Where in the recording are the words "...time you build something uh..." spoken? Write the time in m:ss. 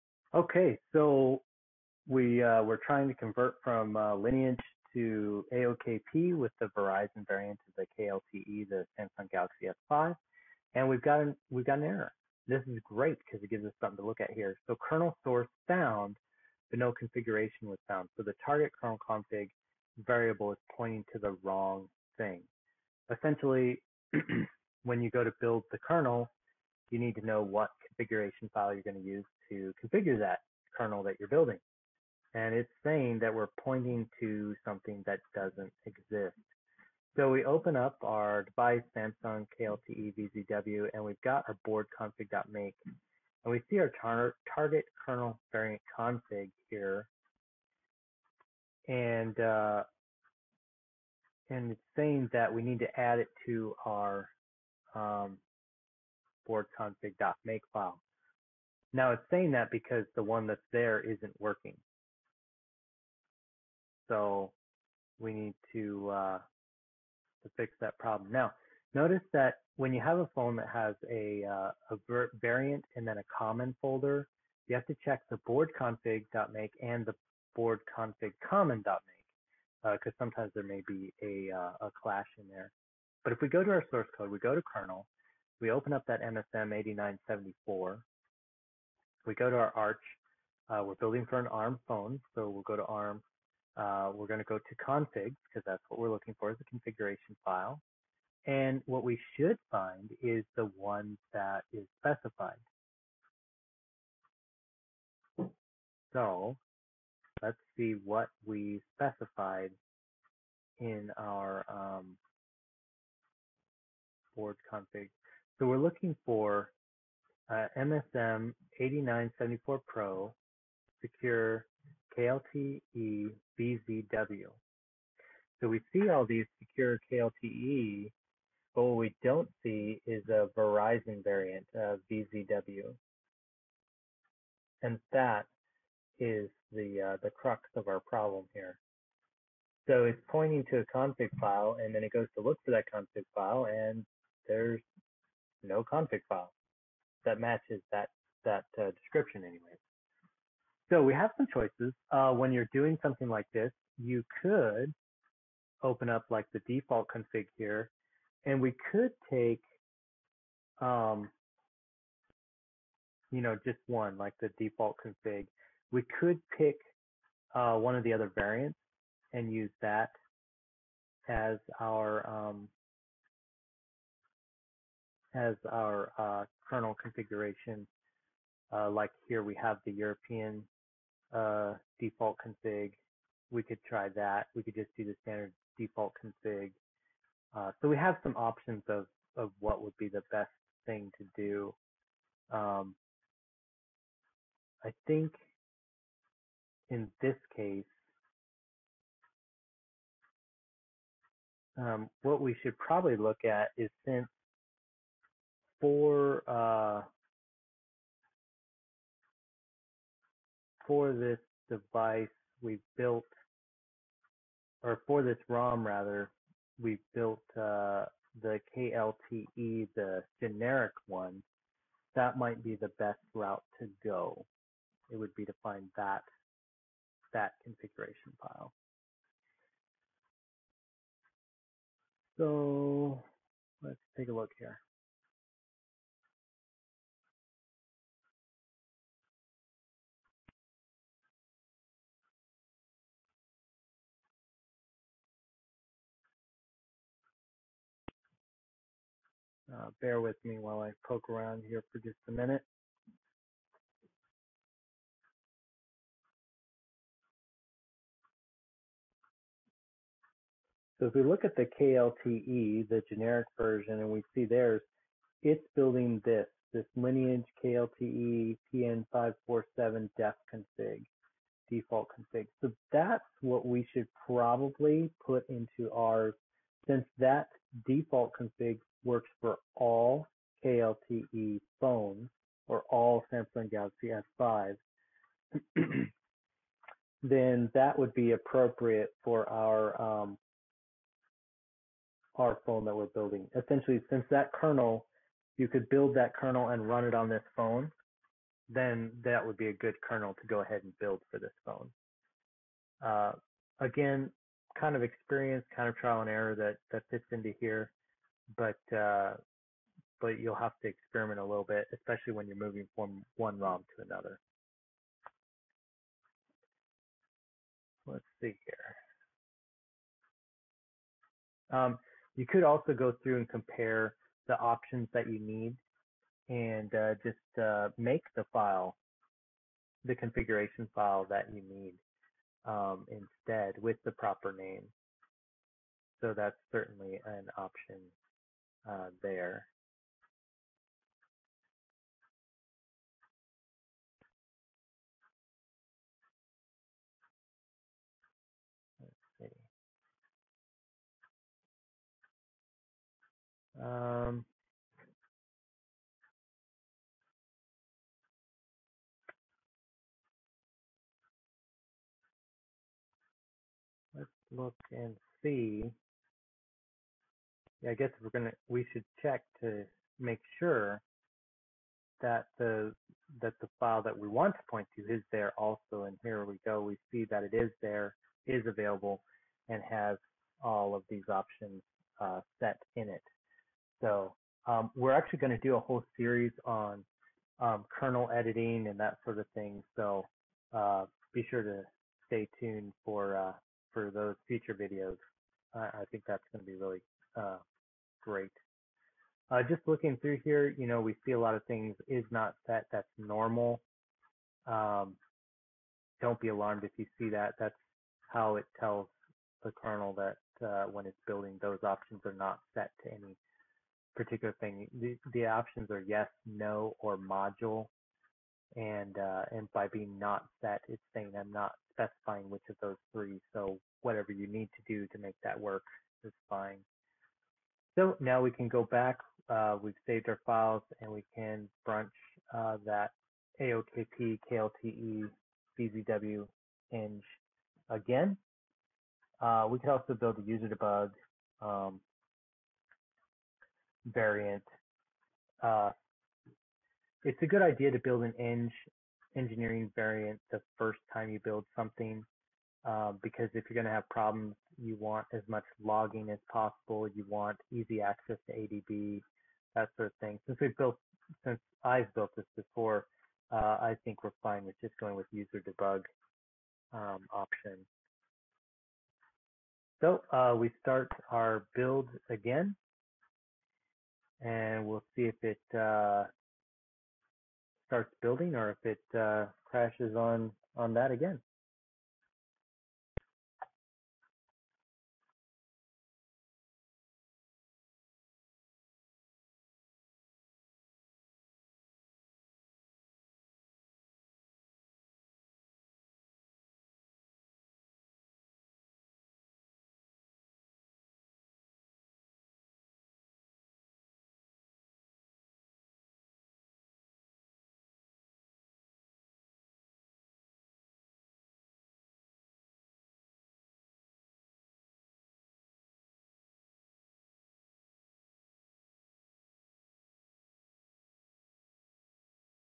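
7:31.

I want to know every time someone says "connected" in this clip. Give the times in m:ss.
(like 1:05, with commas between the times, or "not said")
not said.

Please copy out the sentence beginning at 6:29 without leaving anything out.
So uh, be sure to stay tuned for uh, for those future videos.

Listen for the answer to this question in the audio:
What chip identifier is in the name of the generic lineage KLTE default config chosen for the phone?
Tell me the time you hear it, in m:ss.
4:28.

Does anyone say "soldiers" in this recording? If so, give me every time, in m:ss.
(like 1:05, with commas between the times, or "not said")
not said.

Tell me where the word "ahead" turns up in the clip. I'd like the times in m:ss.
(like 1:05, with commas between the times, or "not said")
5:00.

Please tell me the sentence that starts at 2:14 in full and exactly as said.
And that is the, uh, the crux of our problem here.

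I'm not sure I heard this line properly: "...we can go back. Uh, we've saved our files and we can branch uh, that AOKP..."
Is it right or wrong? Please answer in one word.
right.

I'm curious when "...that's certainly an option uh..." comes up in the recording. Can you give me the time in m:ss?
5:36.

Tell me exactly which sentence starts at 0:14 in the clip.
So kernel source found, but no configuration was found.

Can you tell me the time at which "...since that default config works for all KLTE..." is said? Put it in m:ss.
4:36.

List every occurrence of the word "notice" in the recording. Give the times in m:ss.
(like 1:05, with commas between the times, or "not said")
1:08.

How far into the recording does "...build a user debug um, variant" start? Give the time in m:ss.
7:20.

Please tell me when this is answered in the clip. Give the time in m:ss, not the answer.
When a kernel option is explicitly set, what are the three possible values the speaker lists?
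6:56.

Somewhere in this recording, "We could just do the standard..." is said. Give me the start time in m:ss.
3:04.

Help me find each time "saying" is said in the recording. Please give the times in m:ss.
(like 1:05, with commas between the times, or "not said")
0:32, 0:51, 0:59, 7:01.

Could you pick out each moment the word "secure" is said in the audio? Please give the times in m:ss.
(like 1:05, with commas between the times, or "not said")
2:01, 2:06.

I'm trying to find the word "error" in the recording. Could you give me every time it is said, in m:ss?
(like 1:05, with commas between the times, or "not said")
0:11, 5:06.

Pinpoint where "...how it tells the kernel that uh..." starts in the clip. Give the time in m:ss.
6:48.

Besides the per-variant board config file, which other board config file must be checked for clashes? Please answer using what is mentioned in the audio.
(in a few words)
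board config common.make.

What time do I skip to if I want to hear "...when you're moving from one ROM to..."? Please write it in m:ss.
5:12.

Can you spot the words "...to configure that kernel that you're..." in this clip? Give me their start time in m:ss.
0:29.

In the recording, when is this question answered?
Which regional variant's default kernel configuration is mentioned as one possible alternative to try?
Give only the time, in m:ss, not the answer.
2:59.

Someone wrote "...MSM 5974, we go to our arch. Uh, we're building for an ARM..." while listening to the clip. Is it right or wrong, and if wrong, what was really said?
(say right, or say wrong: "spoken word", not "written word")
wrong: "8974", not "5974".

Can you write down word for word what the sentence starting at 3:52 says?
So let's take a look here.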